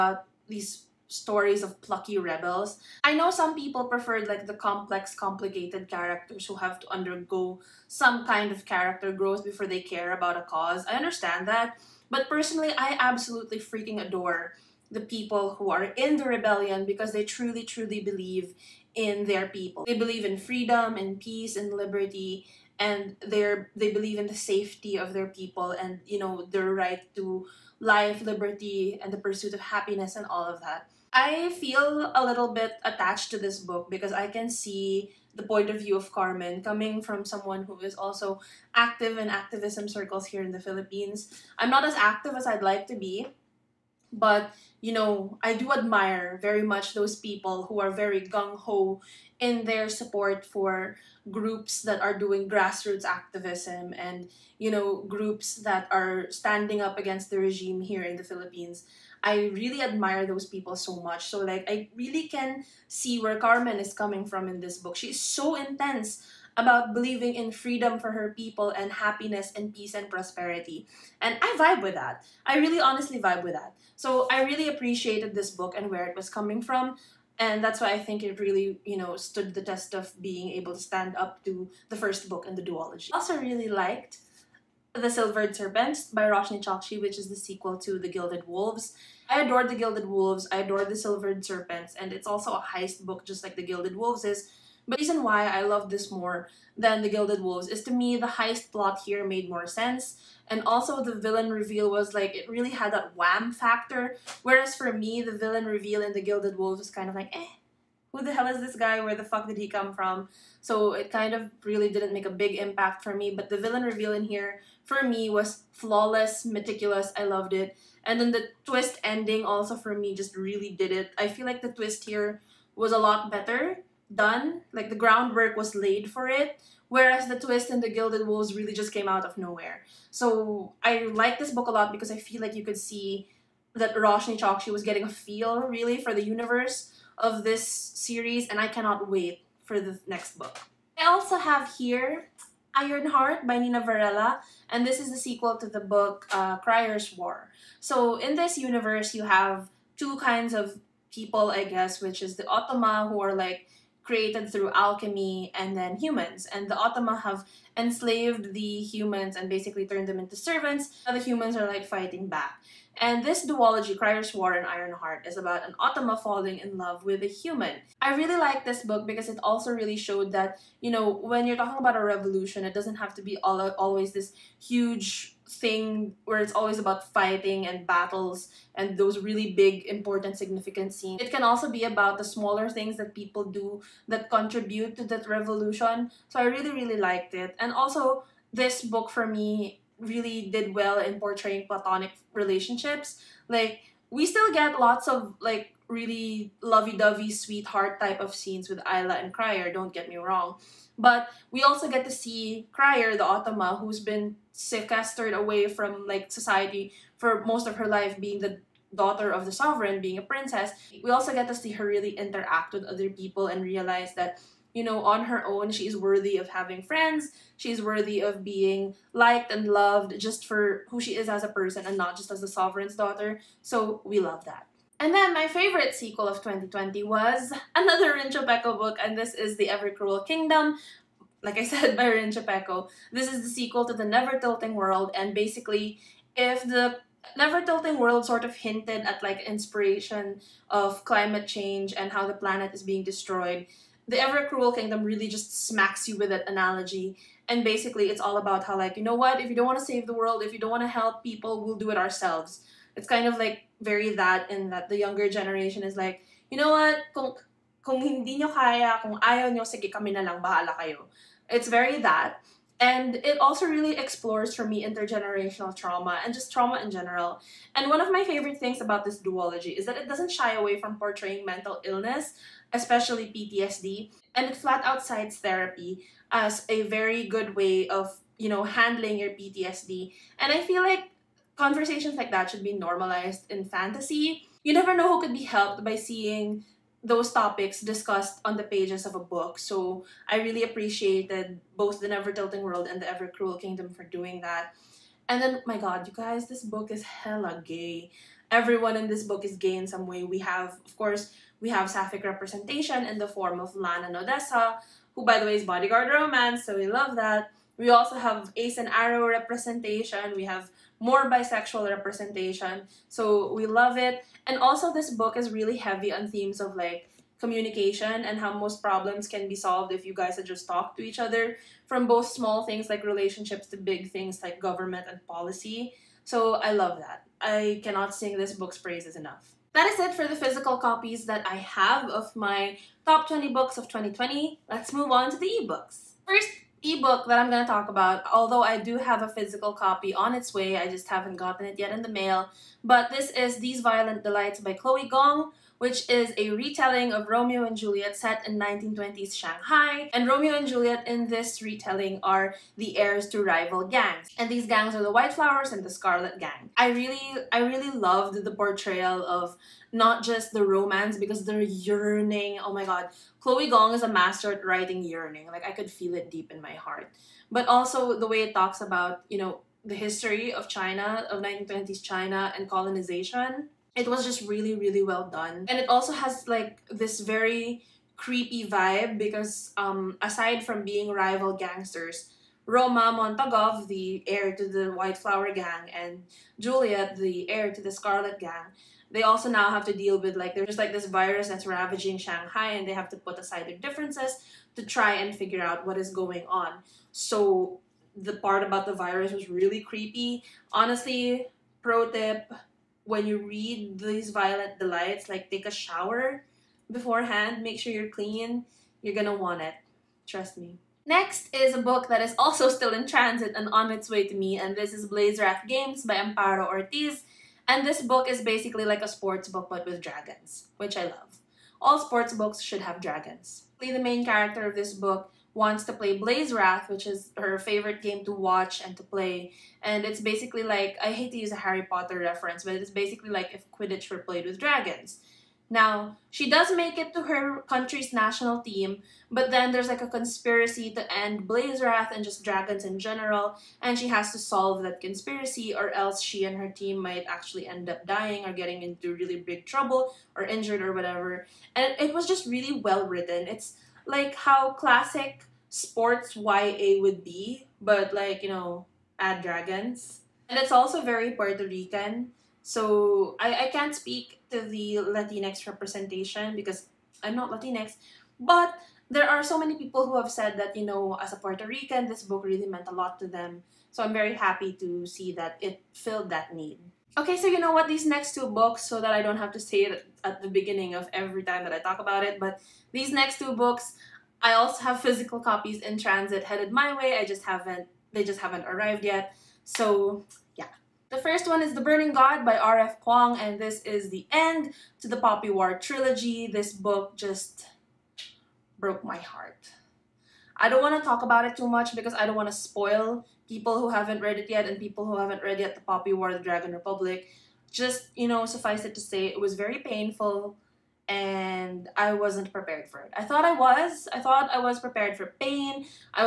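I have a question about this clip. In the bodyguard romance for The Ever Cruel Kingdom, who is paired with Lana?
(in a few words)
Odessa.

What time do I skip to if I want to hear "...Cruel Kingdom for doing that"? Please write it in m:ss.
4:53.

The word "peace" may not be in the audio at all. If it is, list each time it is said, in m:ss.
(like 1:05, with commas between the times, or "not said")
0:21, 1:09.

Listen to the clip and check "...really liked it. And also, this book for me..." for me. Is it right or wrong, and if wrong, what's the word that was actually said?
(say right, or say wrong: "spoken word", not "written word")
right.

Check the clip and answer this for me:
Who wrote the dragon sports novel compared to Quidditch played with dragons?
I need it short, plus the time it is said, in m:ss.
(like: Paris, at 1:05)
Amparo Ortiz, at 6:56.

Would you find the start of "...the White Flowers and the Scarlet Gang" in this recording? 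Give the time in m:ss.
5:55.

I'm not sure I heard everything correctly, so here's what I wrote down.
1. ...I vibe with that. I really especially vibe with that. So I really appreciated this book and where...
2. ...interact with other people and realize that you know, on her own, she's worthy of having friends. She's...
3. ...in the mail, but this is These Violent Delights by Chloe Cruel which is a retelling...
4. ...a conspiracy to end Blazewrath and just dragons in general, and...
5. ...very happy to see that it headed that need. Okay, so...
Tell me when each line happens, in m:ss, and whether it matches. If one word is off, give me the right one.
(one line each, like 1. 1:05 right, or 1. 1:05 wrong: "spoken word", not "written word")
1. 1:11 wrong: "honestly", not "especially"
2. 3:32 right
3. 5:41 wrong: "Gong", not "Cruel"
4. 7:20 right
5. 7:54 wrong: "filled", not "headed".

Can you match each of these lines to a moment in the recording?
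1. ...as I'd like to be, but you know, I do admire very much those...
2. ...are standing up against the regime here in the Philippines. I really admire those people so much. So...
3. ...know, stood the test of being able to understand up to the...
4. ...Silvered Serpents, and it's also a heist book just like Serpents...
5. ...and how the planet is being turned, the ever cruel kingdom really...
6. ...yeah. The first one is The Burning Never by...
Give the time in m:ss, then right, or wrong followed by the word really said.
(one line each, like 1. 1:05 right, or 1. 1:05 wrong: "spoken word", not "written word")
1. 0:42 right
2. 0:55 right
3. 1:18 wrong: "stand", not "understand"
4. 1:30 wrong: "The", not "Serpents"
5. 4:01 wrong: "destroyed", not "turned"
6. 8:10 wrong: "God", not "Never".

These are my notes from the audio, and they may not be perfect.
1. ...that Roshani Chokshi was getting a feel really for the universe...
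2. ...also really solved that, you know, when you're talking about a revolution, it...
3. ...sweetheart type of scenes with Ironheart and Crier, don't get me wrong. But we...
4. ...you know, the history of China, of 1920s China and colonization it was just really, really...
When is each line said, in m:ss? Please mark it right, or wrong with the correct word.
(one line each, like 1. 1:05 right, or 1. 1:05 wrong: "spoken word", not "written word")
1. 2:13 right
2. 2:49 wrong: "showed", not "solved"
3. 3:17 wrong: "Isla", not "Ironheart"
4. 6:09 right.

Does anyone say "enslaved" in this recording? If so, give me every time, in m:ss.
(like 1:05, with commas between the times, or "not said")
2:37.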